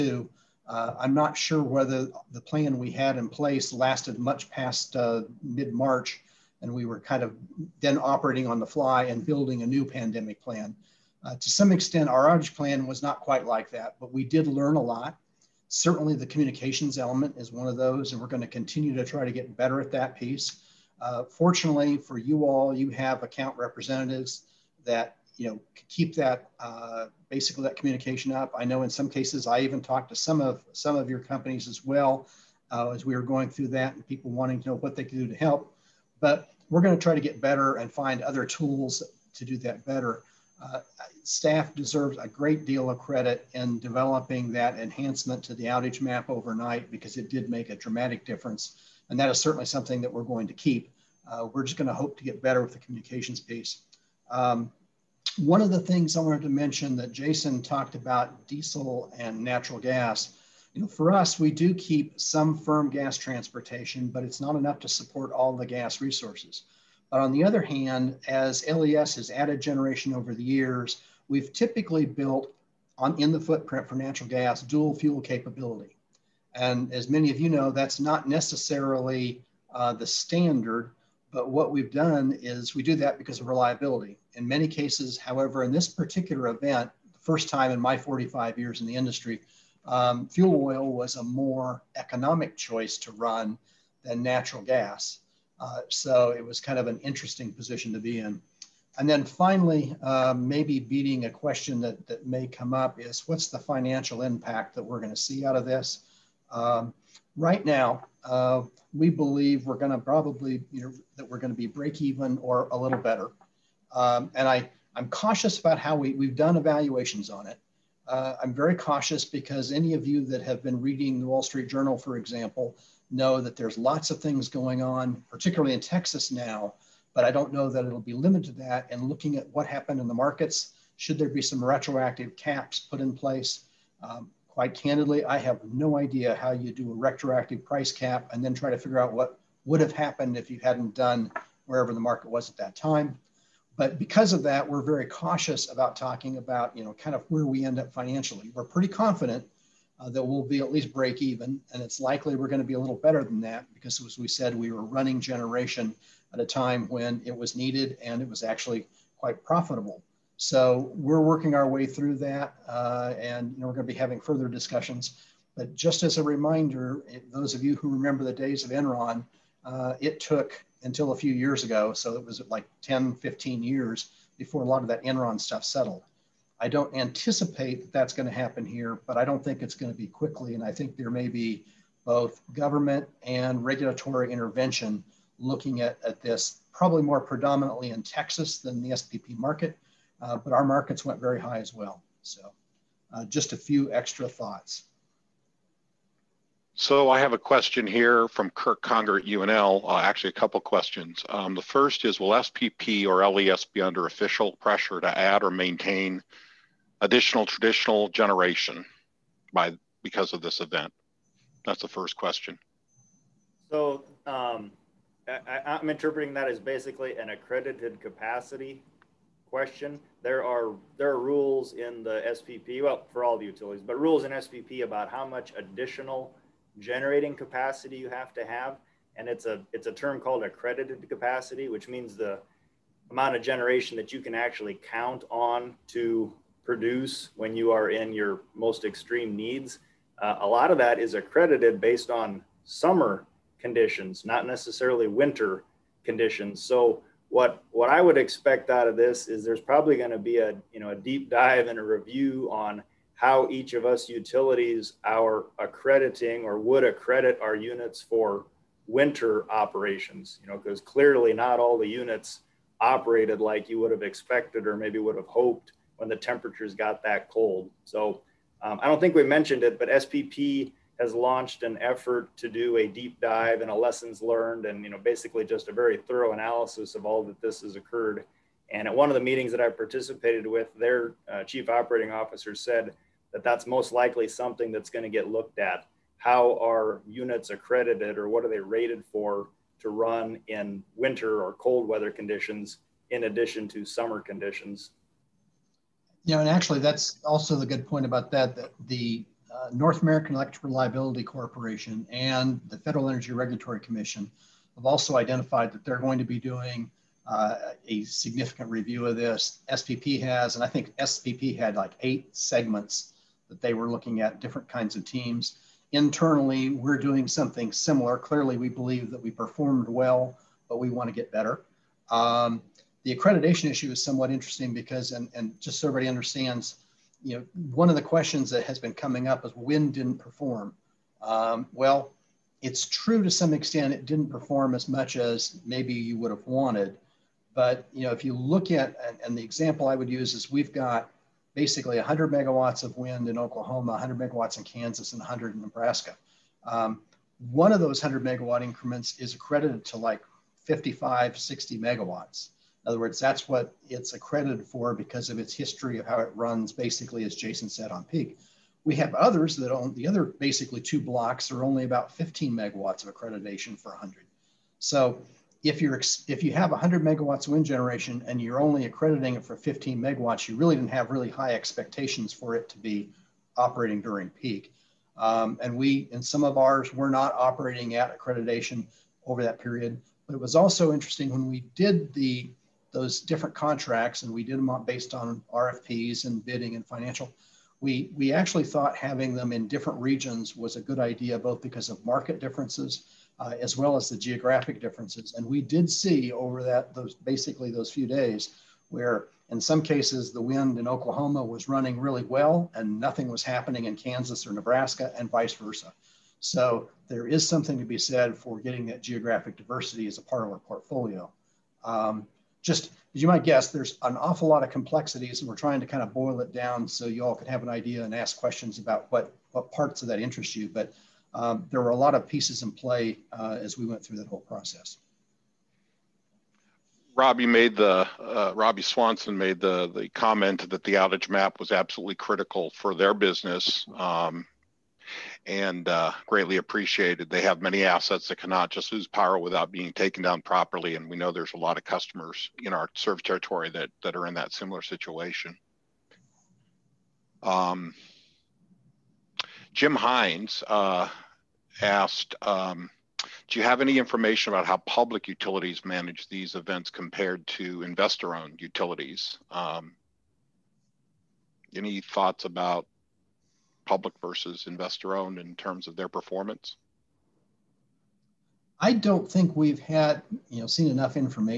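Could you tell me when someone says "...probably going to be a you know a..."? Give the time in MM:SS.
04:09.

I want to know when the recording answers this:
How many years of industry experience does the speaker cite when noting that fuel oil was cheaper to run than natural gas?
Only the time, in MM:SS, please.
01:27.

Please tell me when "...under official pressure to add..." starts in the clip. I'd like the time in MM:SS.
03:23.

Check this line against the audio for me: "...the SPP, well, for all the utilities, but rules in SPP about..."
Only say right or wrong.
right.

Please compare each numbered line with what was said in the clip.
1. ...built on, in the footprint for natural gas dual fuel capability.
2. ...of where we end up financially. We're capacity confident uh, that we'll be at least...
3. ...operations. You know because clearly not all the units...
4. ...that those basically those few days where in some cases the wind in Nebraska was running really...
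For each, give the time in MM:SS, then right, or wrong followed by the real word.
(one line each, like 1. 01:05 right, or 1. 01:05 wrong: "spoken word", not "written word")
1. 01:12 right
2. 02:27 wrong: "pretty", not "capacity"
3. 04:19 right
4. 06:36 wrong: "Oklahoma", not "Nebraska".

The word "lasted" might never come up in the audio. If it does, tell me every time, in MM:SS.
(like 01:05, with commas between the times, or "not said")
00:03.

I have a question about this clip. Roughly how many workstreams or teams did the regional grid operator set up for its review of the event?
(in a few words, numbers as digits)
8.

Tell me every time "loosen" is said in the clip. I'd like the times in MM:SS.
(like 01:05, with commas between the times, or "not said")
not said.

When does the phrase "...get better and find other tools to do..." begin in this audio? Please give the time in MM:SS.
00:37.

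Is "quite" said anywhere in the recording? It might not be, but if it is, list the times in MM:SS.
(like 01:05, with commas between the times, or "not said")
00:13, 02:14, 02:39.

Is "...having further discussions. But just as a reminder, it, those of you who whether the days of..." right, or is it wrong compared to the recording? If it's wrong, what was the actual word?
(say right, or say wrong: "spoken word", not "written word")
wrong: "remember", not "whether".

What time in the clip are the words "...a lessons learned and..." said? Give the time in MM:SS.
04:33.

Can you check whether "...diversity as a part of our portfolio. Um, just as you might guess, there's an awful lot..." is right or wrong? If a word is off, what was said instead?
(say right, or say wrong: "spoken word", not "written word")
right.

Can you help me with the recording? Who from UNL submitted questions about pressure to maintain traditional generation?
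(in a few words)
Kirk Conger.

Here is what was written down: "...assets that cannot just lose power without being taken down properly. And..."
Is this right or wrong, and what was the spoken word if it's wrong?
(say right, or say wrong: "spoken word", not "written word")
right.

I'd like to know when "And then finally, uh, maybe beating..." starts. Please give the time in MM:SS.
01:38.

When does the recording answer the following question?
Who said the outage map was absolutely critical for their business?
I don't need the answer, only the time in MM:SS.
07:08.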